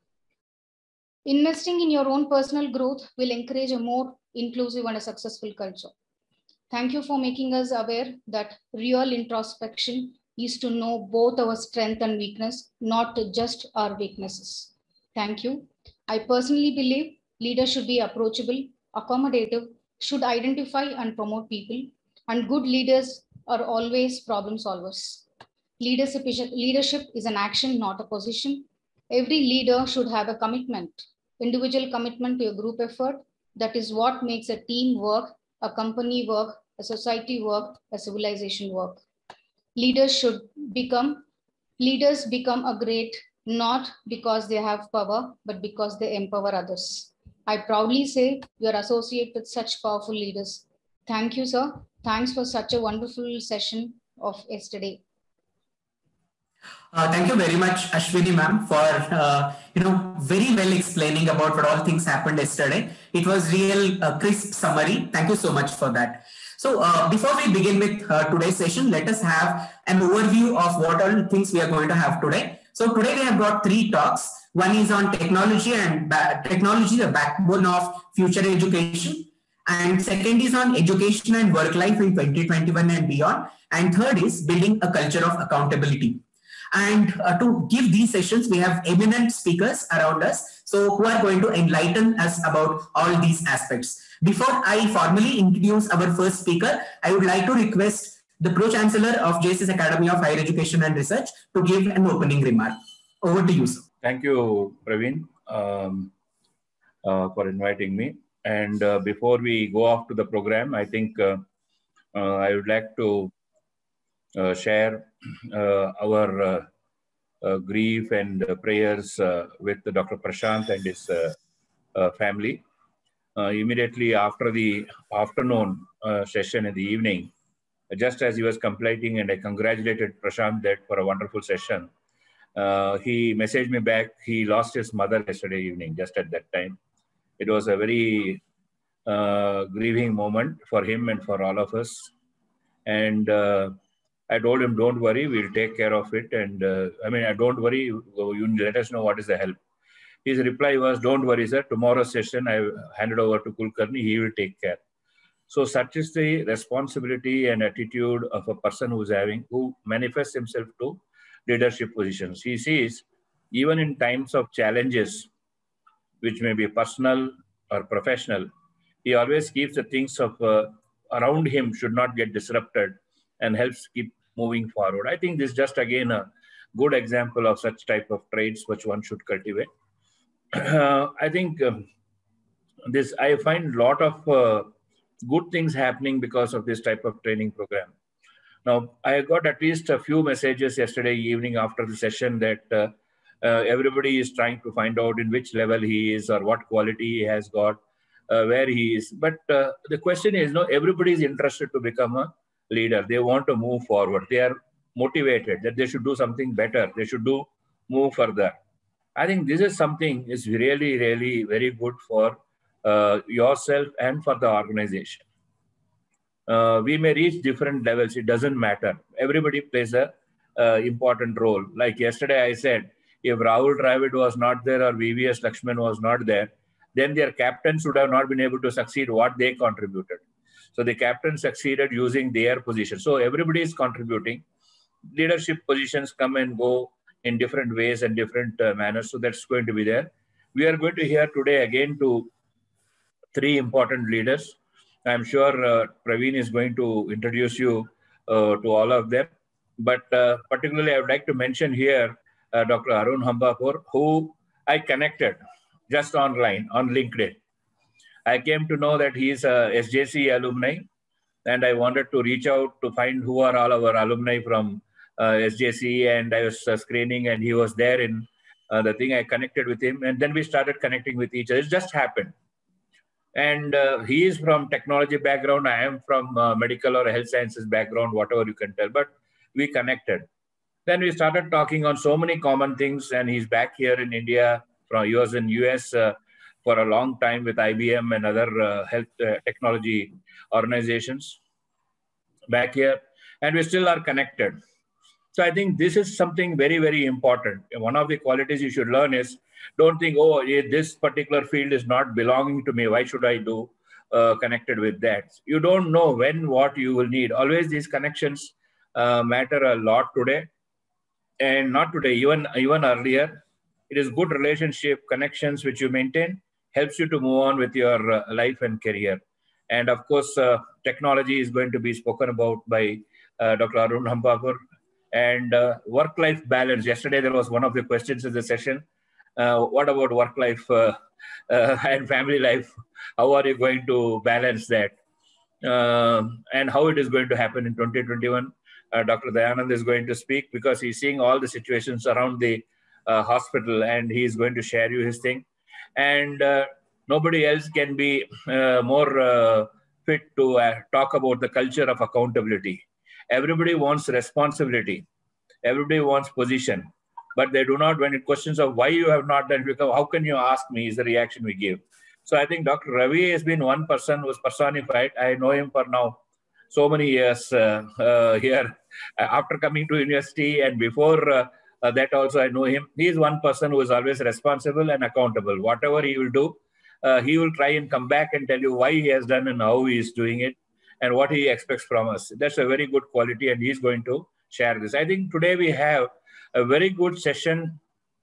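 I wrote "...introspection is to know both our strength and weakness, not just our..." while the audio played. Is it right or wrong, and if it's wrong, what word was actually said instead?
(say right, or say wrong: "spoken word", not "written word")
right.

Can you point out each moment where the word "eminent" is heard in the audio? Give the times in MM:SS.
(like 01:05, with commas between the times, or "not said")
01:28.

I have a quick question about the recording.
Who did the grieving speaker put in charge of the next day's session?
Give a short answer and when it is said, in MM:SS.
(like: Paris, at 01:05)
Kulkarni, at 02:33.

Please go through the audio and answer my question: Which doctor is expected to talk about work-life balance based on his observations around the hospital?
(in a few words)
Dr. Dayanand.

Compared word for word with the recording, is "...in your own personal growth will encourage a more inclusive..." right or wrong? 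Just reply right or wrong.
right.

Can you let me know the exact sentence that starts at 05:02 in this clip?
Why should I do uh, connected with that?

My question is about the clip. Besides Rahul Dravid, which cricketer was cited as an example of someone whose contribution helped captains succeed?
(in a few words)
VVS Lakshman.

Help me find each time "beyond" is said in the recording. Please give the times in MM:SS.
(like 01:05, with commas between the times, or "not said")
01:23.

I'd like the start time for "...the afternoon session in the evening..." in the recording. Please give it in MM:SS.
02:04.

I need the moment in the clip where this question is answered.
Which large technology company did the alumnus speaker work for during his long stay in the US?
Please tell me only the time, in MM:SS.
04:47.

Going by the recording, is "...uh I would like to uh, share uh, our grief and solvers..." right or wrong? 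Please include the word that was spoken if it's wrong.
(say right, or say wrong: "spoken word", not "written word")
wrong: "prayers", not "solvers".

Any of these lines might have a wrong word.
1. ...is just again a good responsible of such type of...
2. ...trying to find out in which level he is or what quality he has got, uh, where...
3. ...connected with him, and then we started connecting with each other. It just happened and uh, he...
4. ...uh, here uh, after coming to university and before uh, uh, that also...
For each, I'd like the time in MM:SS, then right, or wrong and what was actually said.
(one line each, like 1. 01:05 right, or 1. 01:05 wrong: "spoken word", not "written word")
1. 02:55 wrong: "example", not "responsible"
2. 03:14 right
3. 04:29 right
4. 06:07 right.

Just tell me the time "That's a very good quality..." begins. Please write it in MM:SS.
06:22.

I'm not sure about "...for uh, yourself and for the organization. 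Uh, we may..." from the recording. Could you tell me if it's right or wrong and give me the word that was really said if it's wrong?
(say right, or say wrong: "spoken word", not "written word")
right.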